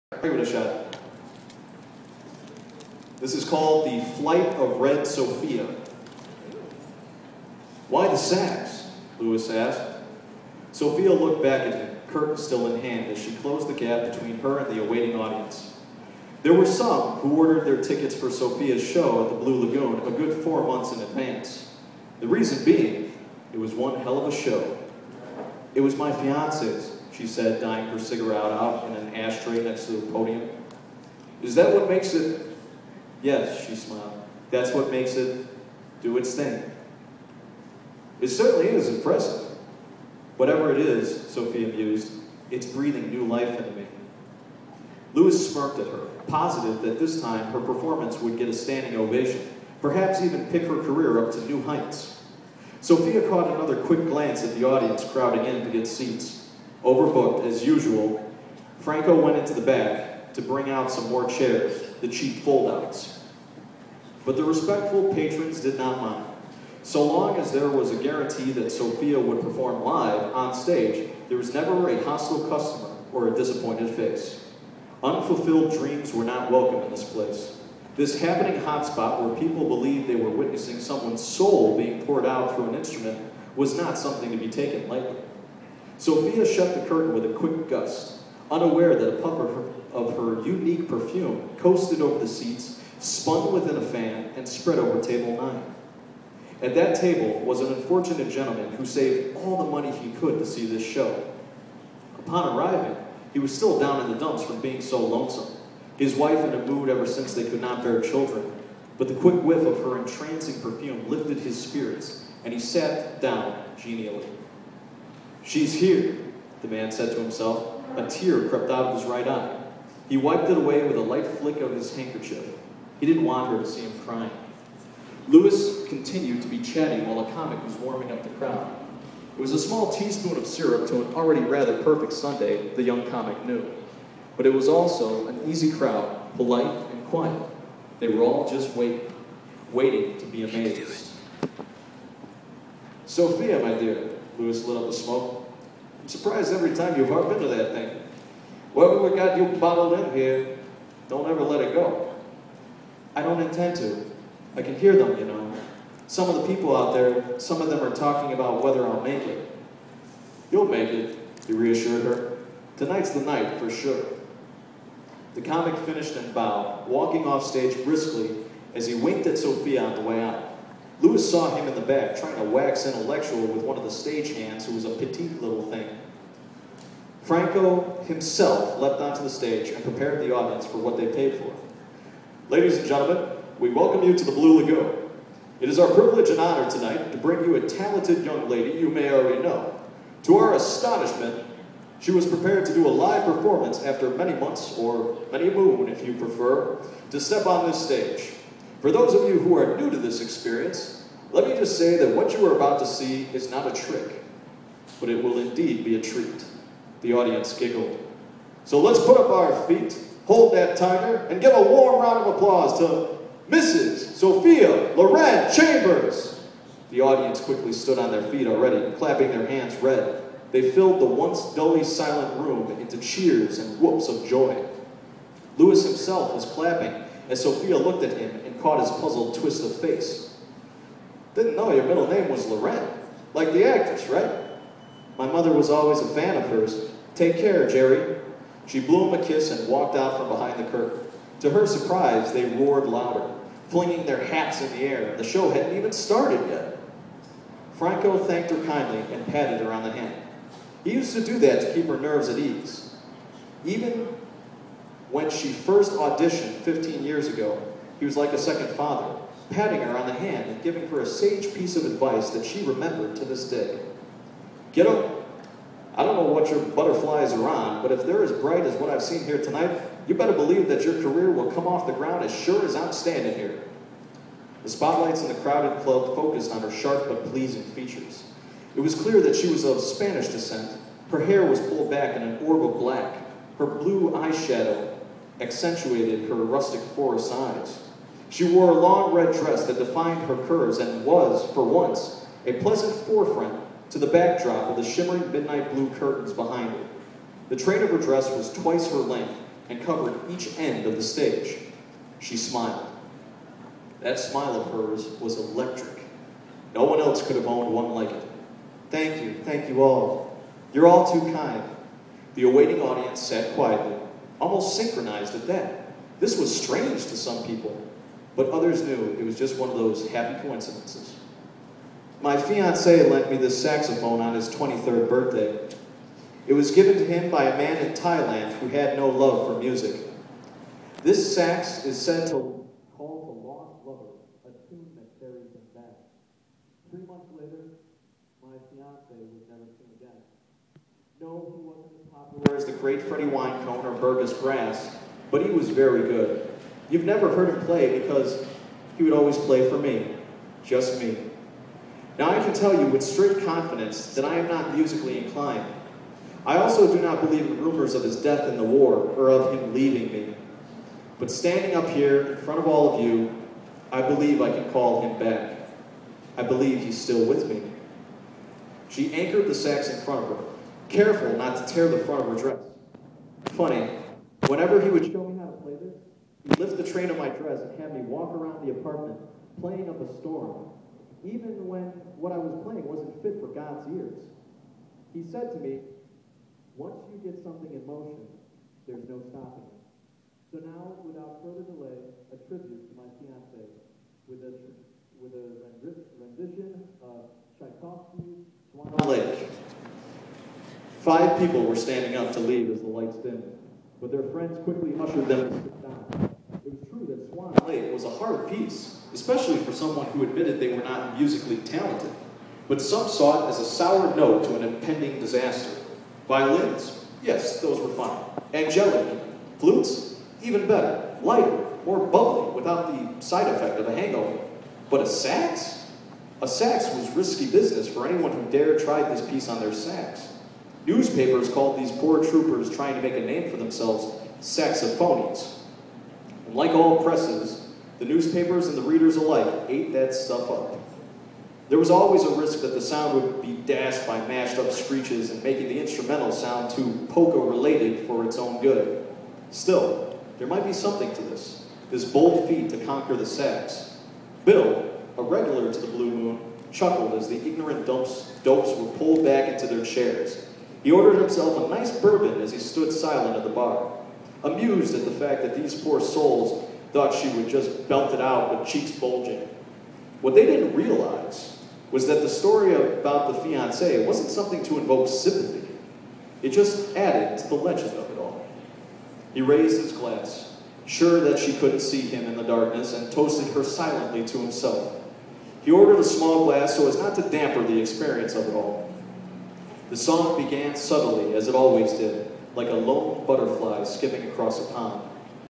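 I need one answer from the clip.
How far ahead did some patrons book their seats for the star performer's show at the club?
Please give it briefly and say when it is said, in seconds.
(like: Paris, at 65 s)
4 months, at 20 s.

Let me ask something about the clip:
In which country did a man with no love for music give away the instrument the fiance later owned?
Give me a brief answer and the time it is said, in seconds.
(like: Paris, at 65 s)
Thailand, at 327 s.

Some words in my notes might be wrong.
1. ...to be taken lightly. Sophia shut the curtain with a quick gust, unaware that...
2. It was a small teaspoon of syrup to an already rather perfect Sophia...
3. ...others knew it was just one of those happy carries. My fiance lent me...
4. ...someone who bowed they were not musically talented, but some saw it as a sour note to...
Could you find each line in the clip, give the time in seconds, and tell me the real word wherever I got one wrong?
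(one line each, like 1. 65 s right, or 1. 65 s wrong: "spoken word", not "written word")
1. 84 s right
2. 129 s wrong: "Sunday", not "Sophia"
3. 318 s wrong: "coincidences", not "carries"
4. 409 s wrong: "admitted", not "bowed".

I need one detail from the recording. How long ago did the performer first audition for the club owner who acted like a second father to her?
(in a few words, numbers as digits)
15 years.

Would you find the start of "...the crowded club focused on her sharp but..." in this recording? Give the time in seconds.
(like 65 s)
275 s.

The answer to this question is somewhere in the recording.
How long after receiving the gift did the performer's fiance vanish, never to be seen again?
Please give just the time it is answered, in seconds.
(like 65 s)
336 s.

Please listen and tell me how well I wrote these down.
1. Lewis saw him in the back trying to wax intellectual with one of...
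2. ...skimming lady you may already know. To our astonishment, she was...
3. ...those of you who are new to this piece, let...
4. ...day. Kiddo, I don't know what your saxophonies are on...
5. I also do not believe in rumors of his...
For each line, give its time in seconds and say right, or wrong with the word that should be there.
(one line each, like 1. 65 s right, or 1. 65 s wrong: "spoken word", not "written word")
1. 171 s right
2. 188 s wrong: "young", not "skimming"
3. 198 s wrong: "experience", not "piece"
4. 263 s wrong: "butterflies", not "saxophonies"
5. 356 s right.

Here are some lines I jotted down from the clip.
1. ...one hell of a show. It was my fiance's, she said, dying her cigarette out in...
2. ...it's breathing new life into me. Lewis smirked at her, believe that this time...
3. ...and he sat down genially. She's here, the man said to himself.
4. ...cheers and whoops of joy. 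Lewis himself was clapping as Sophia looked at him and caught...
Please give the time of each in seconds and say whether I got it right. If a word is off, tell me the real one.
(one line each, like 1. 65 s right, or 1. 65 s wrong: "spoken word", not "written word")
1. 23 s right
2. 42 s wrong: "positive", not "believe"
3. 112 s right
4. 222 s right.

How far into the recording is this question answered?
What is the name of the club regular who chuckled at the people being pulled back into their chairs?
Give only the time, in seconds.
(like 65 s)
454 s.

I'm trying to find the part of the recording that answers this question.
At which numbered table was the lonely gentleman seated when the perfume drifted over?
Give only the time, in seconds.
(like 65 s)
94 s.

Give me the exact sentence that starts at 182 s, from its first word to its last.
Ladies and gentlemen, we welcome you to the Blue Lagoon.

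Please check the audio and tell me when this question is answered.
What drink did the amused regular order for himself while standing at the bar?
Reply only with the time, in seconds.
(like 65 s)
461 s.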